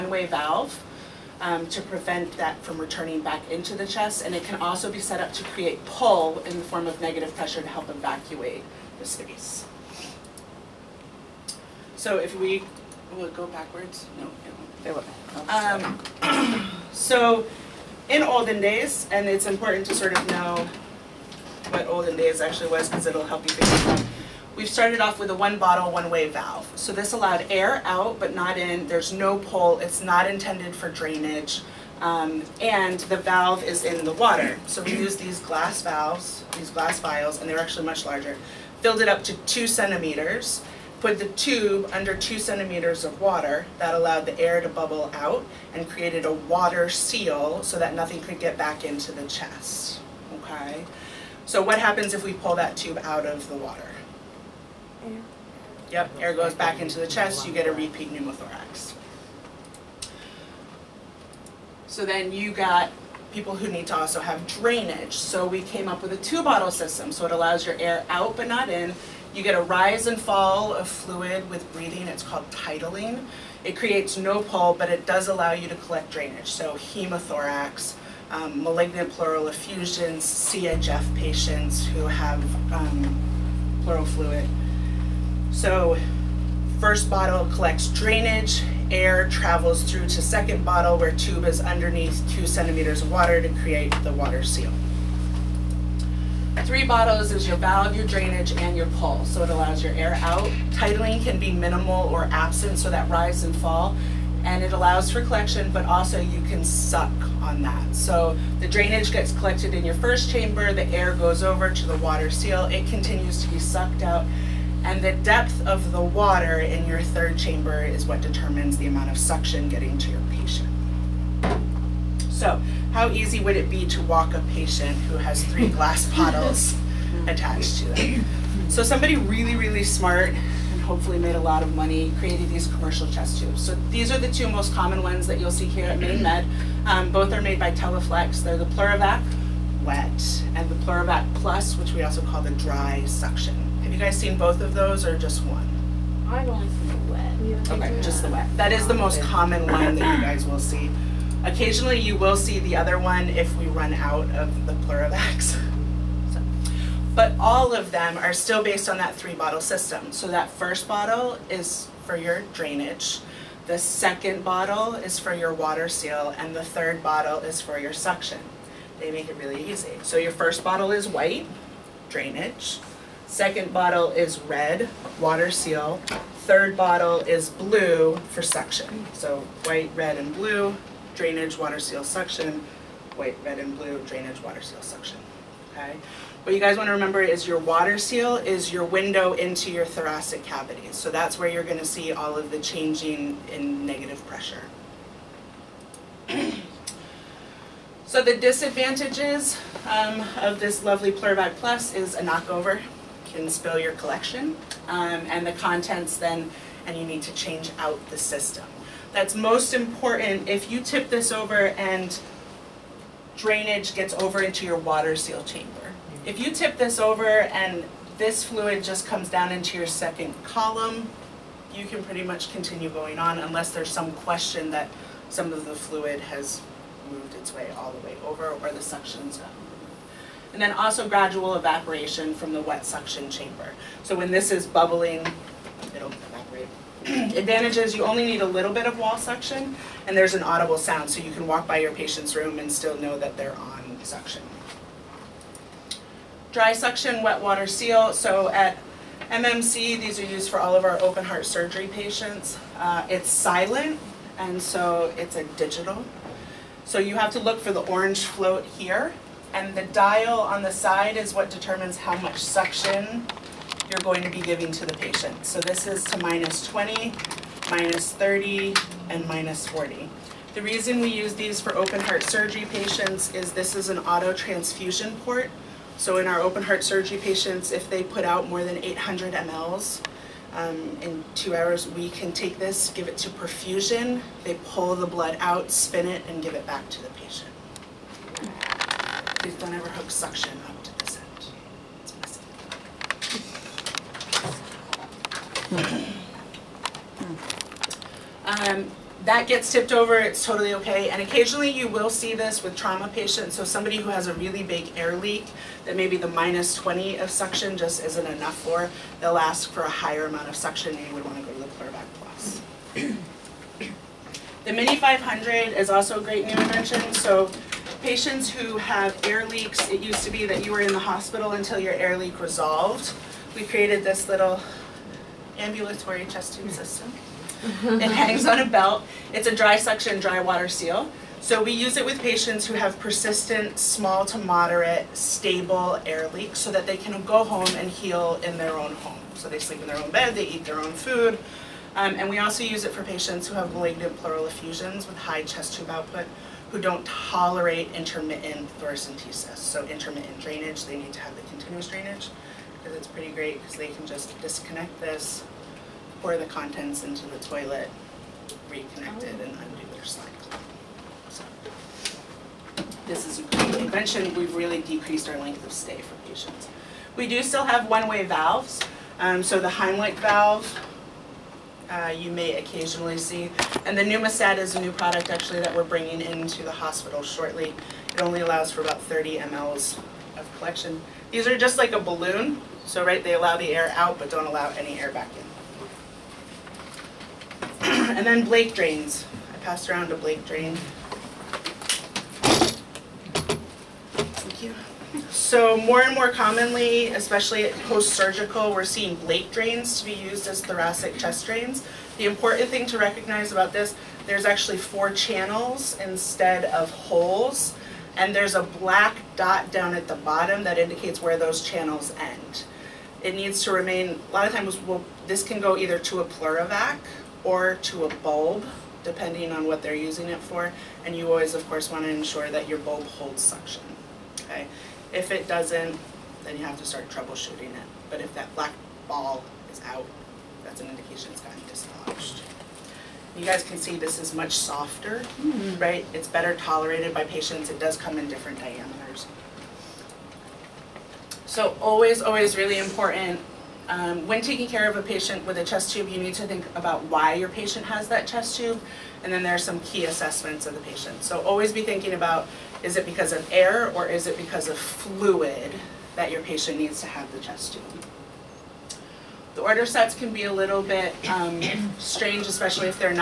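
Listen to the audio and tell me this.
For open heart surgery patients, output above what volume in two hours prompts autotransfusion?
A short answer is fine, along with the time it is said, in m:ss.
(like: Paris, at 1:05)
800 mL, at 4:38.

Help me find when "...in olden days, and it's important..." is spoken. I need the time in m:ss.
0:18.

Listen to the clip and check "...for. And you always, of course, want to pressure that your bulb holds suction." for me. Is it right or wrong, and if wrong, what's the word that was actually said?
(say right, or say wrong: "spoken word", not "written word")
wrong: "ensure", not "pressure".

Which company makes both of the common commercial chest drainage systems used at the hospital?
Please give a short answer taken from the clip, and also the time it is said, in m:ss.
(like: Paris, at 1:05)
Teleflex, at 2:17.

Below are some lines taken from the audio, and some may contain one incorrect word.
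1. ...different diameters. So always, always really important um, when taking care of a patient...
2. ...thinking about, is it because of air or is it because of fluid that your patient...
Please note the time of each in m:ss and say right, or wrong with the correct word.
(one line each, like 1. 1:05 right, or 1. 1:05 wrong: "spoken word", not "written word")
1. 7:18 right
2. 7:31 right.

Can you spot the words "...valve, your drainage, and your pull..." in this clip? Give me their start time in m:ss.
1:37.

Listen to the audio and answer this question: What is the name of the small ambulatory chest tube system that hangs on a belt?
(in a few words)
Mini 500.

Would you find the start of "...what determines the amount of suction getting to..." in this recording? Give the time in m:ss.
1:58.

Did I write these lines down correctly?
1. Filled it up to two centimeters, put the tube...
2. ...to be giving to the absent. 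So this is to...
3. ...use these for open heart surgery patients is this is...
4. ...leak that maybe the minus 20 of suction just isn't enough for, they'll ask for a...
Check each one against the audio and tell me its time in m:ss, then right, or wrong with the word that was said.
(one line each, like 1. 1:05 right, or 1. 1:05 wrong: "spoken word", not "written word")
1. 0:38 right
2. 4:24 wrong: "patient", not "absent"
3. 4:31 right
4. 5:05 right.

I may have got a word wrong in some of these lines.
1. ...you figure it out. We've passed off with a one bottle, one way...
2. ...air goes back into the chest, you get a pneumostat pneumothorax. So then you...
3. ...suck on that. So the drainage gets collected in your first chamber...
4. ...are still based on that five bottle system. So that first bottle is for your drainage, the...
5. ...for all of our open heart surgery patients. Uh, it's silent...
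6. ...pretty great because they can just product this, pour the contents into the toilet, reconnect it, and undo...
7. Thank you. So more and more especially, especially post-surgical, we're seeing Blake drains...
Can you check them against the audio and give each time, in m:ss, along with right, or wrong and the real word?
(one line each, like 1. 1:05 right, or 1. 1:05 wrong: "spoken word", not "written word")
1. 0:23 wrong: "started", not "passed"
2. 0:56 wrong: "repeat", not "pneumostat"
3. 1:46 right
4. 2:38 wrong: "three", not "five"
5. 4:10 right
6. 5:53 wrong: "disconnect", not "product"
7. 6:34 wrong: "commonly", not "especially".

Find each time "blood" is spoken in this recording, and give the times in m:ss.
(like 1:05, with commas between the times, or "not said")
4:45.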